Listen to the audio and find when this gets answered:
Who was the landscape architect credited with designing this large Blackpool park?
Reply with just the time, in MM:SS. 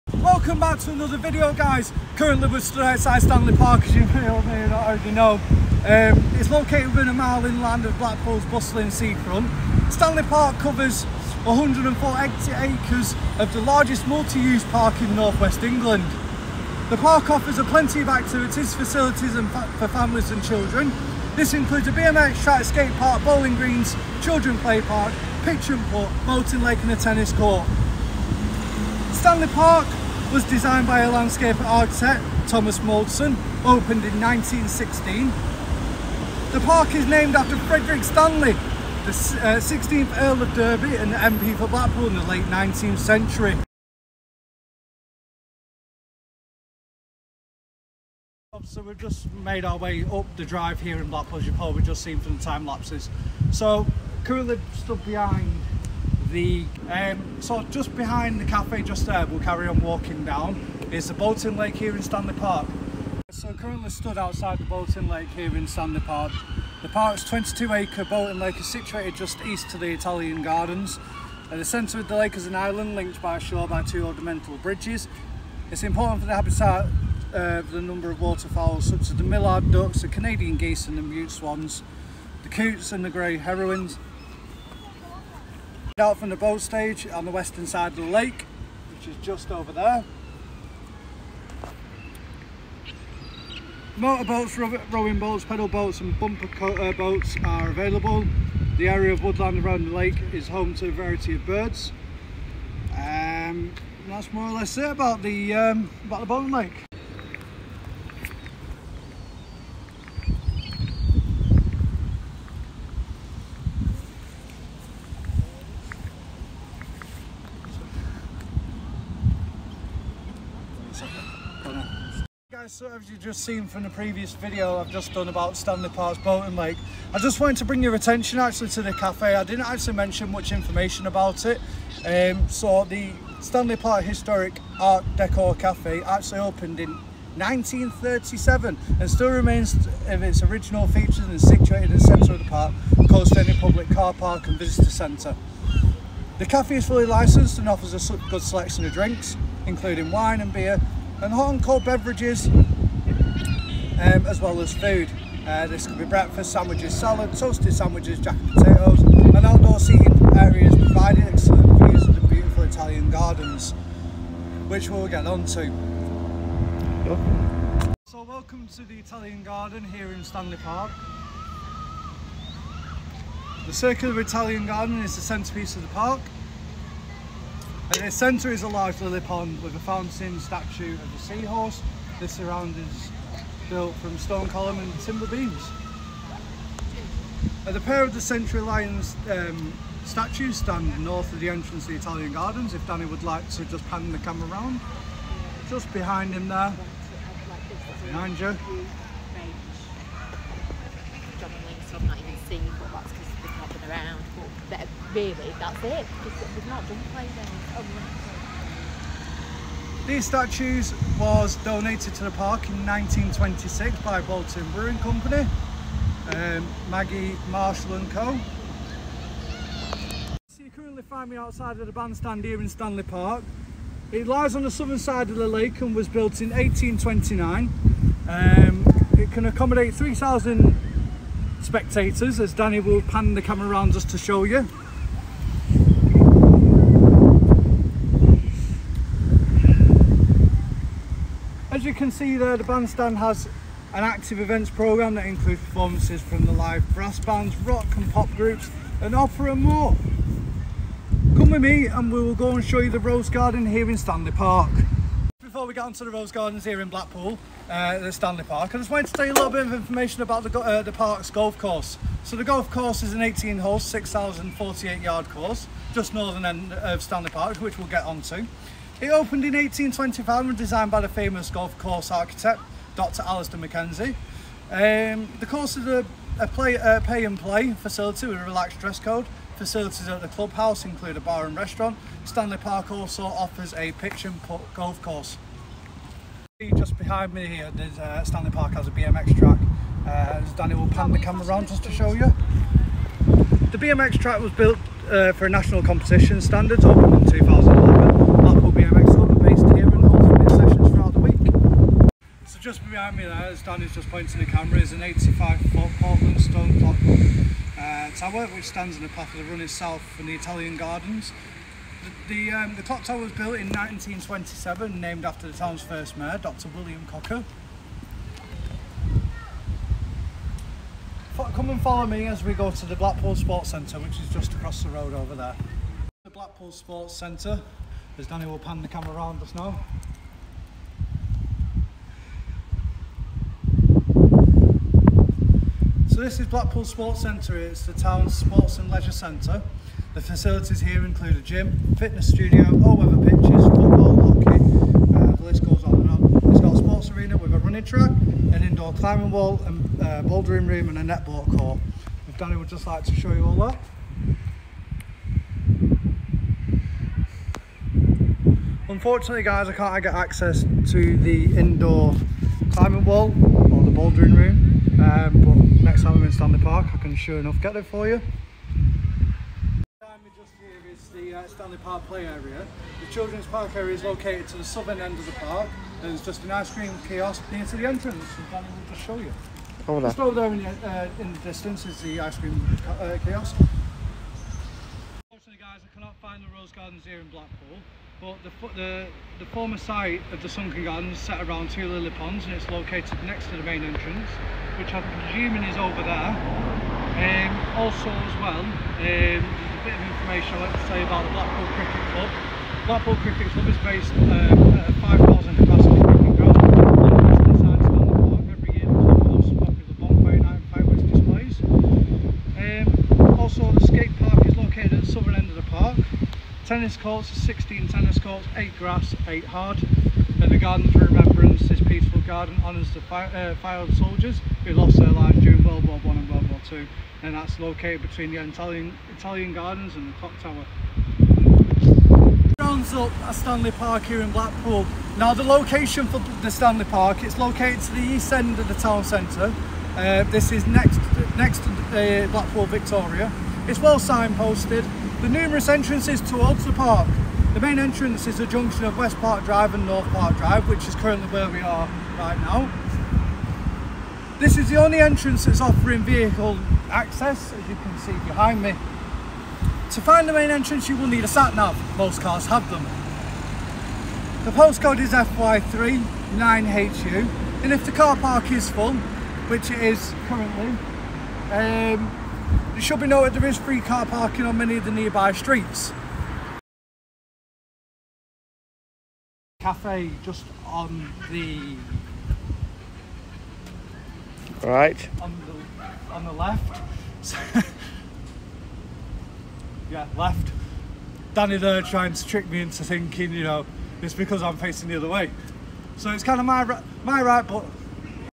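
00:32.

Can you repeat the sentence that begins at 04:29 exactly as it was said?
It opened in 1825 and designed by the famous golf course architect, Dr.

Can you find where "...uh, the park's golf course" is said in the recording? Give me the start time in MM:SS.
04:20.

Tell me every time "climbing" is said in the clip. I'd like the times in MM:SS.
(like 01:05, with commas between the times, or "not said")
05:48, 06:02.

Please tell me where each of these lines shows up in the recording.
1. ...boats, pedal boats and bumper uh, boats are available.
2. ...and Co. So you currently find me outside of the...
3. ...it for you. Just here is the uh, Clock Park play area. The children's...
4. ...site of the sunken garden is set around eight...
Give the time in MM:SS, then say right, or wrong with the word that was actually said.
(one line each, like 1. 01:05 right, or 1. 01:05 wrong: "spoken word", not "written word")
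1. 01:35 right
2. 03:37 right
3. 06:07 wrong: "Stanley", not "Clock"
4. 06:29 wrong: "two", not "eight".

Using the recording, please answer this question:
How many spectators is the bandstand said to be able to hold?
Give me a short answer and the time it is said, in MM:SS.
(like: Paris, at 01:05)
3,000, at 03:49.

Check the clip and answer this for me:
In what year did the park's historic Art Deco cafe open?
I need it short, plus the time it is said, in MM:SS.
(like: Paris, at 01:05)
1937, at 02:17.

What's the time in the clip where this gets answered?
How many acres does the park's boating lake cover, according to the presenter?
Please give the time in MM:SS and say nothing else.
01:07.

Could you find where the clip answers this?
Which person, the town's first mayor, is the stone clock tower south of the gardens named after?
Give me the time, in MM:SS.
05:16.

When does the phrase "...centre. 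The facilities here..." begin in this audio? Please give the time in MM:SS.
05:39.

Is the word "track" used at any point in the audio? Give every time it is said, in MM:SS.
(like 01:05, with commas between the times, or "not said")
00:22, 04:49, 04:54, 05:47.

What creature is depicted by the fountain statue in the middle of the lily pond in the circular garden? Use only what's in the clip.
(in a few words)
Seahorse.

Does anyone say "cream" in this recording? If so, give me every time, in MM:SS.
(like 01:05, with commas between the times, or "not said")
06:16, 06:22.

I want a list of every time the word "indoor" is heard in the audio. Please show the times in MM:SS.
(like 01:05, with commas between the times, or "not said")
05:48, 06:01.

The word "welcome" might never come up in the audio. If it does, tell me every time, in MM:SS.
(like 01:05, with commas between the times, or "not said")
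00:00, 02:48.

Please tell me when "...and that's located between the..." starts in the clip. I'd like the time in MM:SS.
07:07.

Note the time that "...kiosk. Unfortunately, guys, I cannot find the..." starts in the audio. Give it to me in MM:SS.
06:23.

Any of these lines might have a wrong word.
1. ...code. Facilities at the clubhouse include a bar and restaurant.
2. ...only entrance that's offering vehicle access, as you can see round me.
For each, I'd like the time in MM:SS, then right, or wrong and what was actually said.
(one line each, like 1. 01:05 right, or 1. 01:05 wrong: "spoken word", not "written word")
1. 04:38 right
2. 07:34 wrong: "behind", not "round".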